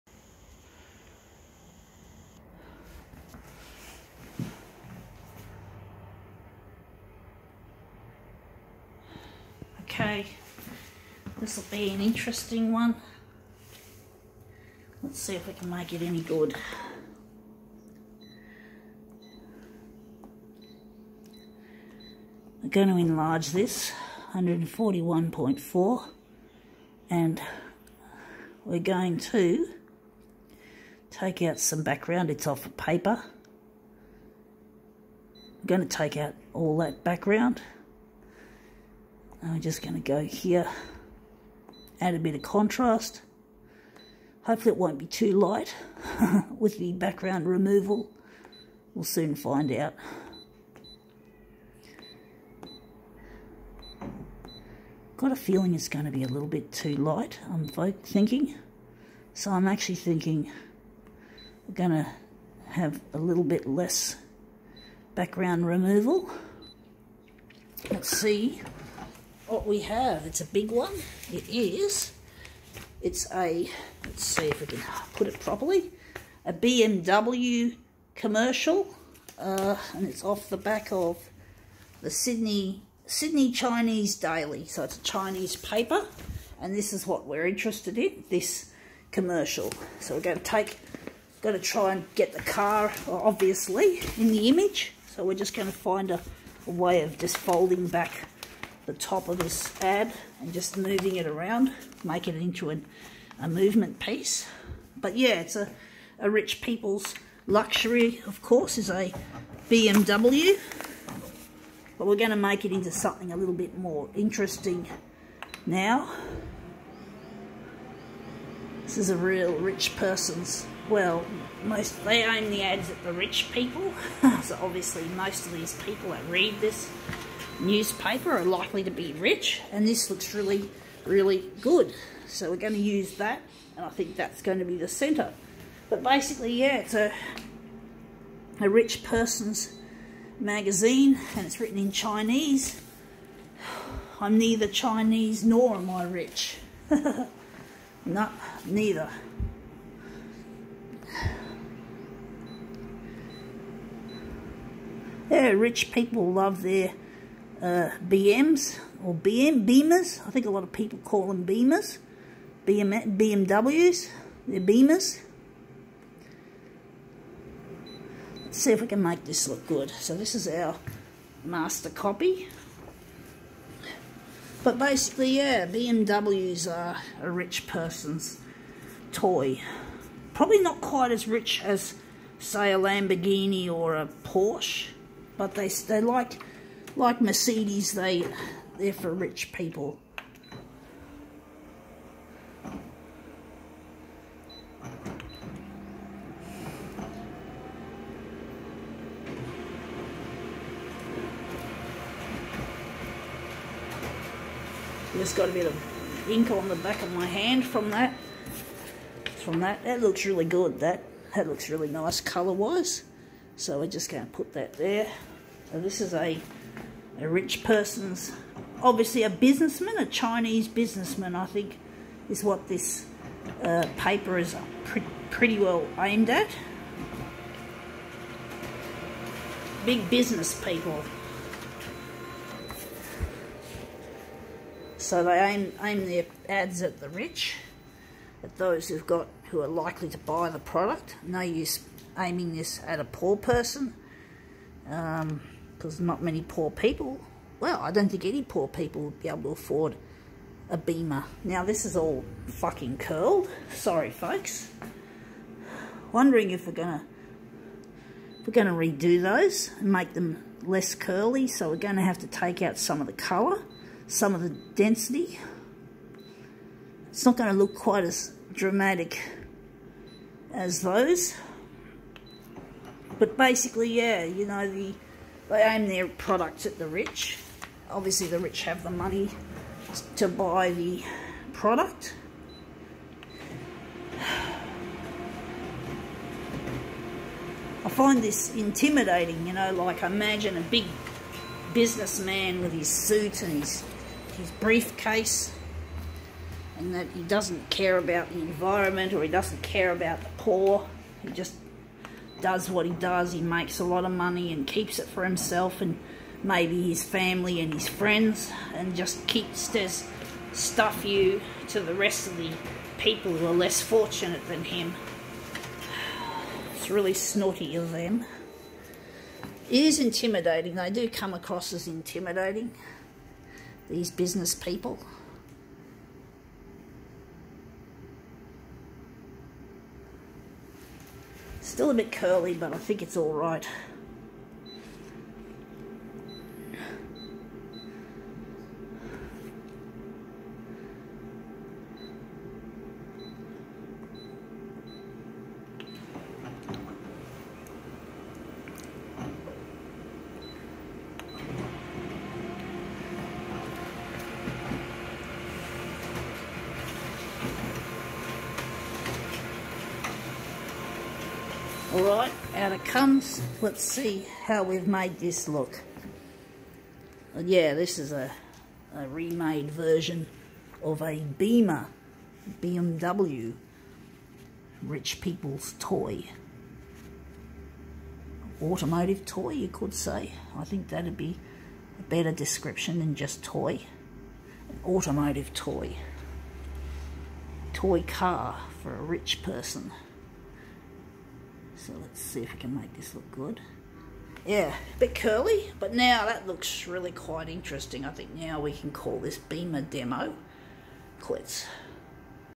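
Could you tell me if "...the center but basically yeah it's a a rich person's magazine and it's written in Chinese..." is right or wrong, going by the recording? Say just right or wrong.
right.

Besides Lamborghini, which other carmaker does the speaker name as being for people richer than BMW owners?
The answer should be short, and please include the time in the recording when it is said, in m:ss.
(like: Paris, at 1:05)
Porsche, at 3:04.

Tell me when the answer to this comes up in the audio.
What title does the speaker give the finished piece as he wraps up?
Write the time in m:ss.
6:39.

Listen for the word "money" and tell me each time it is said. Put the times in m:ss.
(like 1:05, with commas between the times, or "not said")
4:38, 5:04.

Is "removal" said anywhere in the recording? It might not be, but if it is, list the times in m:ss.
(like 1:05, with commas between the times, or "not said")
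0:47, 1:05.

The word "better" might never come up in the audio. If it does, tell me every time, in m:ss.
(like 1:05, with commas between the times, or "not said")
6:22.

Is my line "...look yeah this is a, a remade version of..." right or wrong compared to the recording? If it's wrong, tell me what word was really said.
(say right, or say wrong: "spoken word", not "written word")
right.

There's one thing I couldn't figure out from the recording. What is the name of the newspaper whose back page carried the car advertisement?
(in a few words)
Sydney Chinese Daily.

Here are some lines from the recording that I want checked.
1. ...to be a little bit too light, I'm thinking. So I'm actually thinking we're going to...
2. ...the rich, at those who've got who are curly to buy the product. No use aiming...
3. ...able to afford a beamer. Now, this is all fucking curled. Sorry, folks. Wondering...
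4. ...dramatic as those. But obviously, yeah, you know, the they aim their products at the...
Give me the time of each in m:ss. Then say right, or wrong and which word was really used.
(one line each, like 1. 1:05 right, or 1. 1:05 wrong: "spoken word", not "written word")
1. 0:56 right
2. 3:56 wrong: "likely", not "curly"
3. 4:09 right
4. 4:28 wrong: "basically", not "obviously".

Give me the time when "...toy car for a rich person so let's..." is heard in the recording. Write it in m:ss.
6:27.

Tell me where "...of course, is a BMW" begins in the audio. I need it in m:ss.
1:48.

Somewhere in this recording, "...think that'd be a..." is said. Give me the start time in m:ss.
6:20.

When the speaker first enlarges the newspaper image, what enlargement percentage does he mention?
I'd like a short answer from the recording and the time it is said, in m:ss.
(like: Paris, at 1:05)
141.4, at 0:24.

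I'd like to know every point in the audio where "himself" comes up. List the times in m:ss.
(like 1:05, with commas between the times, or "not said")
5:05.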